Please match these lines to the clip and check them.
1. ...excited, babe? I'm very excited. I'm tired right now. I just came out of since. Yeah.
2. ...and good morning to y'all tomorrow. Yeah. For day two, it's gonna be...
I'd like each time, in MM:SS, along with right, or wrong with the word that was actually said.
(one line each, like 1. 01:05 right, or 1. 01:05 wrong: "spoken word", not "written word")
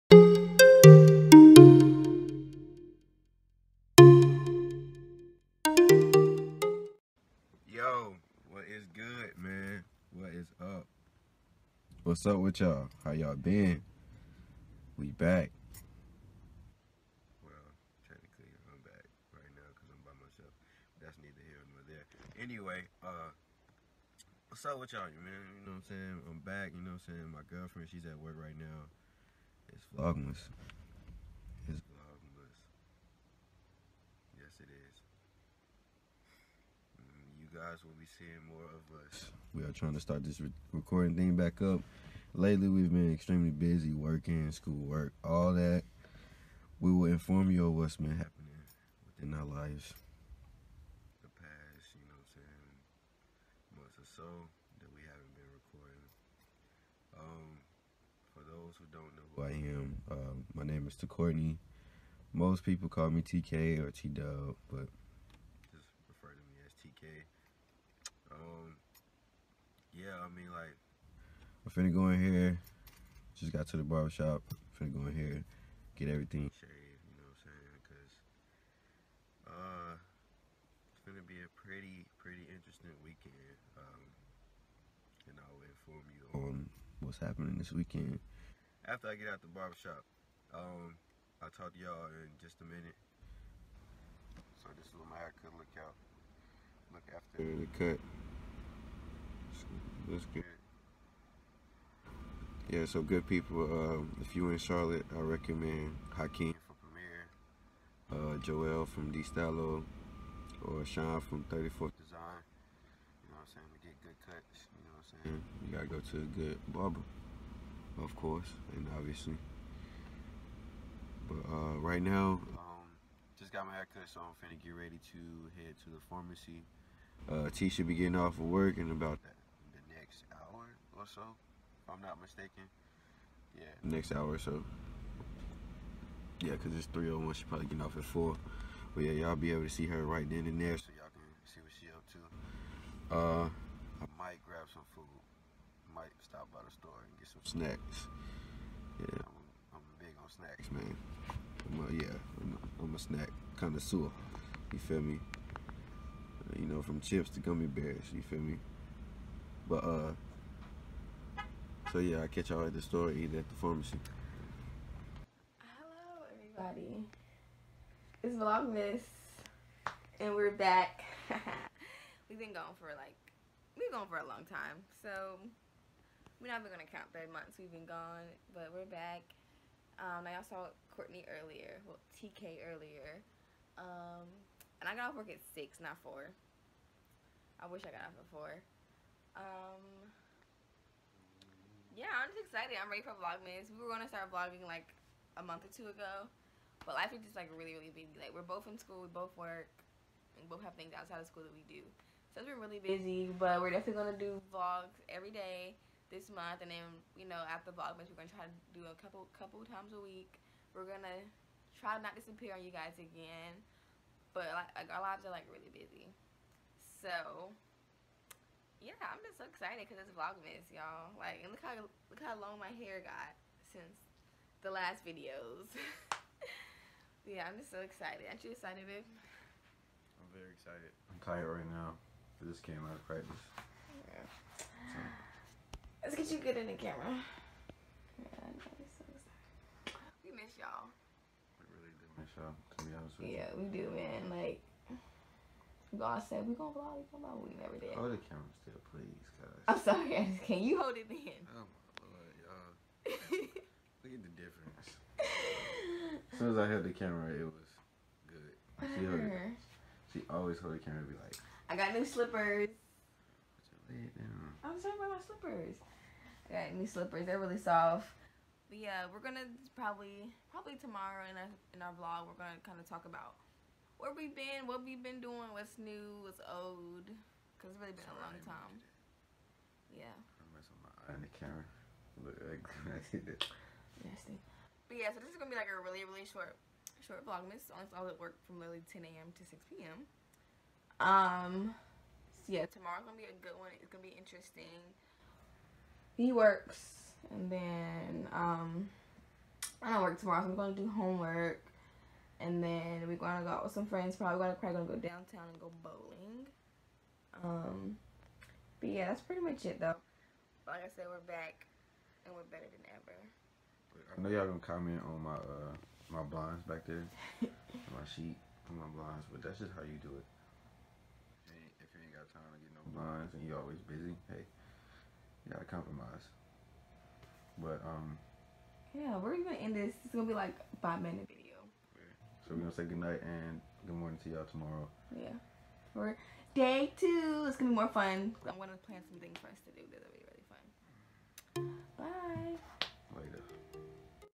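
1. 03:48 wrong: "practice", not "since"
2. 05:33 right.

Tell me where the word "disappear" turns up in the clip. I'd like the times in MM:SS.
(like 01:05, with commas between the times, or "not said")
03:32.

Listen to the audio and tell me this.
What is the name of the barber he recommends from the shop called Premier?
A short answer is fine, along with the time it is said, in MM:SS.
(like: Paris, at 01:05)
Hakeem, at 01:46.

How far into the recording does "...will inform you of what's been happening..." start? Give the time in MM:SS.
00:46.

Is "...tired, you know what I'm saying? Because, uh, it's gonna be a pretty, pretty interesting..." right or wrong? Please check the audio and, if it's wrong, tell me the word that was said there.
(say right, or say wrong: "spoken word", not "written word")
wrong: "shaved", not "tired".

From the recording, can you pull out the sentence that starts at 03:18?
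Like we're both in school, we both work, and both have things outside of school that we do.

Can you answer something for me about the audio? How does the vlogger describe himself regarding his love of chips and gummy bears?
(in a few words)
snack connoisseur.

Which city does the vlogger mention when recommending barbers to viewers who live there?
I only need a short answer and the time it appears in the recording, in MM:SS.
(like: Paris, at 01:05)
Charlotte, at 01:44.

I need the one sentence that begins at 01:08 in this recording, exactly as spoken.
Um, yeah, I mean, like, I'm finna go in here.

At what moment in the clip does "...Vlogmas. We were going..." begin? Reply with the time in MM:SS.
03:13.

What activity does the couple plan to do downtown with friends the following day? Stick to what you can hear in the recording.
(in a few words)
bowling.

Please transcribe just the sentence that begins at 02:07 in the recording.
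Uh, T should be getting off of work in about that next hour or so, if I'm not mistaken.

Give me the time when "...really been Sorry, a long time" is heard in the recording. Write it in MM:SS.
04:37.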